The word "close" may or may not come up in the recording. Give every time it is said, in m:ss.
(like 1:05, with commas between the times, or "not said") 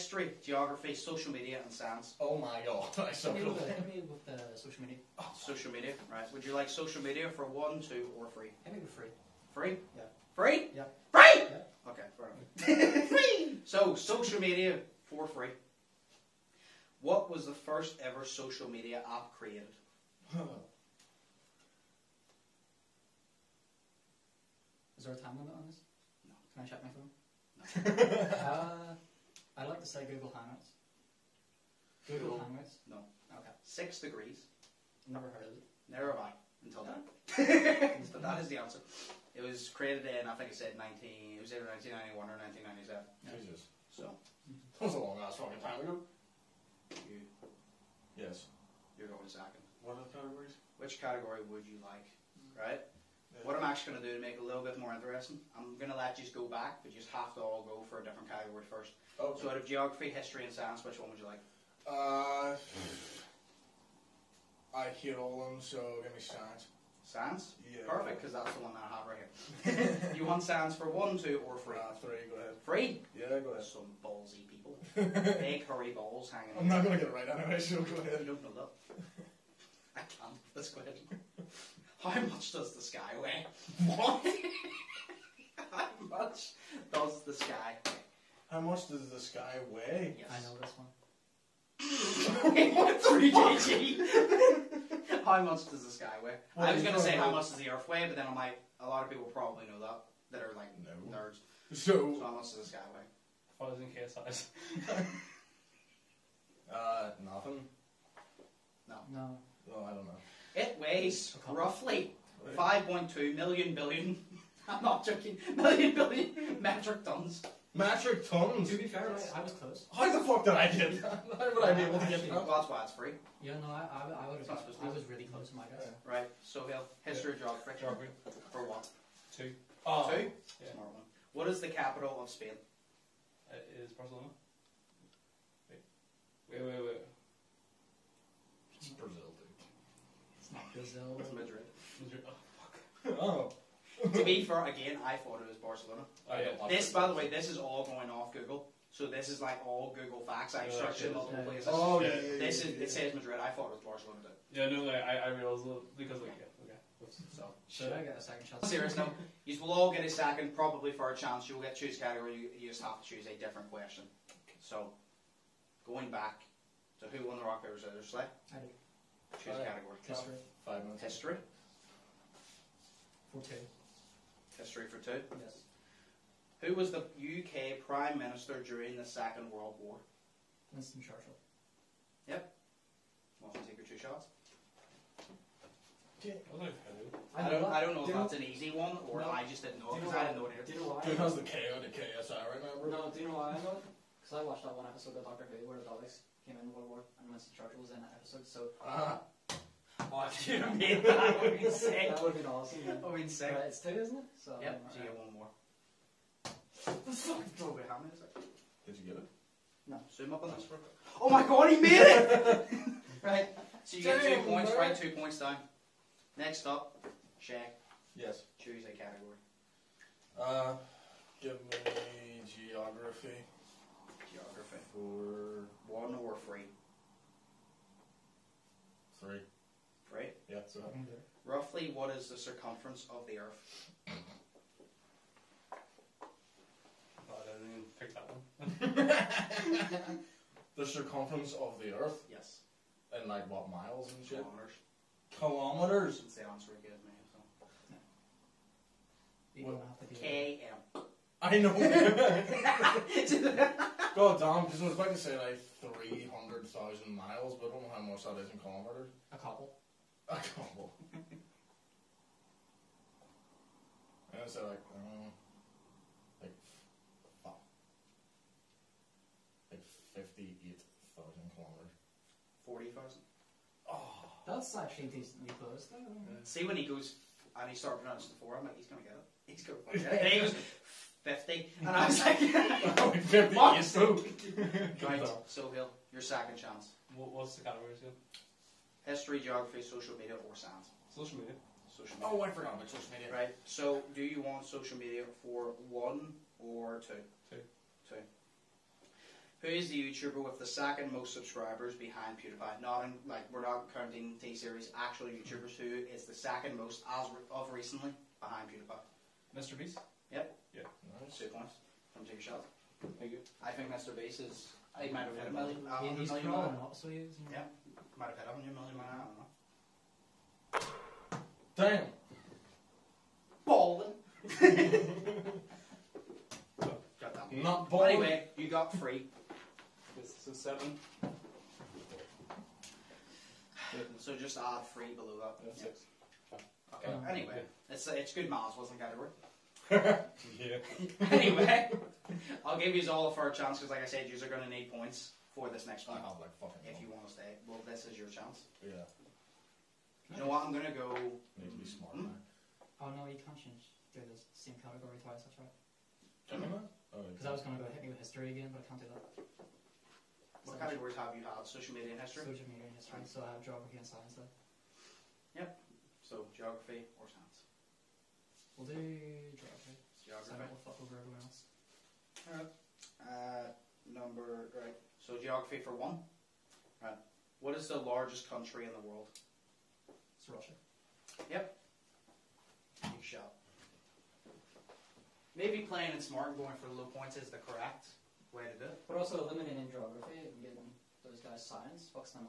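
1:59, 2:05, 4:35.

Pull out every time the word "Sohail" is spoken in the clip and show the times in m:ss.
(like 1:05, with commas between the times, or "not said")
2:06, 4:45.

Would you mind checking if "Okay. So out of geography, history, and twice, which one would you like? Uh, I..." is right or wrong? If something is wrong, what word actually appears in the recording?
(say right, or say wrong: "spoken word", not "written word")
wrong: "science", not "twice".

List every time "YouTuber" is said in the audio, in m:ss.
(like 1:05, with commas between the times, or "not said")
5:00, 5:05.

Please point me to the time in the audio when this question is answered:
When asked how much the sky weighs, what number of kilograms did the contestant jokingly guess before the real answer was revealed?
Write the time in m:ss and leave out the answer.
1:33.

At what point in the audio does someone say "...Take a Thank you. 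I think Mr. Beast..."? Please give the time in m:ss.
5:12.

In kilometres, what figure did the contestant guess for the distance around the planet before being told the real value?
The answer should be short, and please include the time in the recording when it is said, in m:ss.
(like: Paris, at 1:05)
58,000, at 4:30.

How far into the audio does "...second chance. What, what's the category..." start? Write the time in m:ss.
4:46.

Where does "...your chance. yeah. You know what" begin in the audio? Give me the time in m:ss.
5:48.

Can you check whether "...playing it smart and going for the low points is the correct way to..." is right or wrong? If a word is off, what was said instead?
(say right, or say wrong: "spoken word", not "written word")
right.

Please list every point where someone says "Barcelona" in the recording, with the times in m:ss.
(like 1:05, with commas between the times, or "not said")
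2:13, 2:25, 2:33.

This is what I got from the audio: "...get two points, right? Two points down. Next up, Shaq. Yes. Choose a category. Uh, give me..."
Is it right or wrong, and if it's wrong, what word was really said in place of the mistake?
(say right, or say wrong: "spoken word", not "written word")
right.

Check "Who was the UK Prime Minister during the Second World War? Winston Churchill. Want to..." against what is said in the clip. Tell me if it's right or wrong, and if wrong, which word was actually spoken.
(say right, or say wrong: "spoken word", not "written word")
right.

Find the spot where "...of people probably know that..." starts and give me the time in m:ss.
1:39.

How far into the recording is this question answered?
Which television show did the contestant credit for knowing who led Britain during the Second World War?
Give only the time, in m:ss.
3:15.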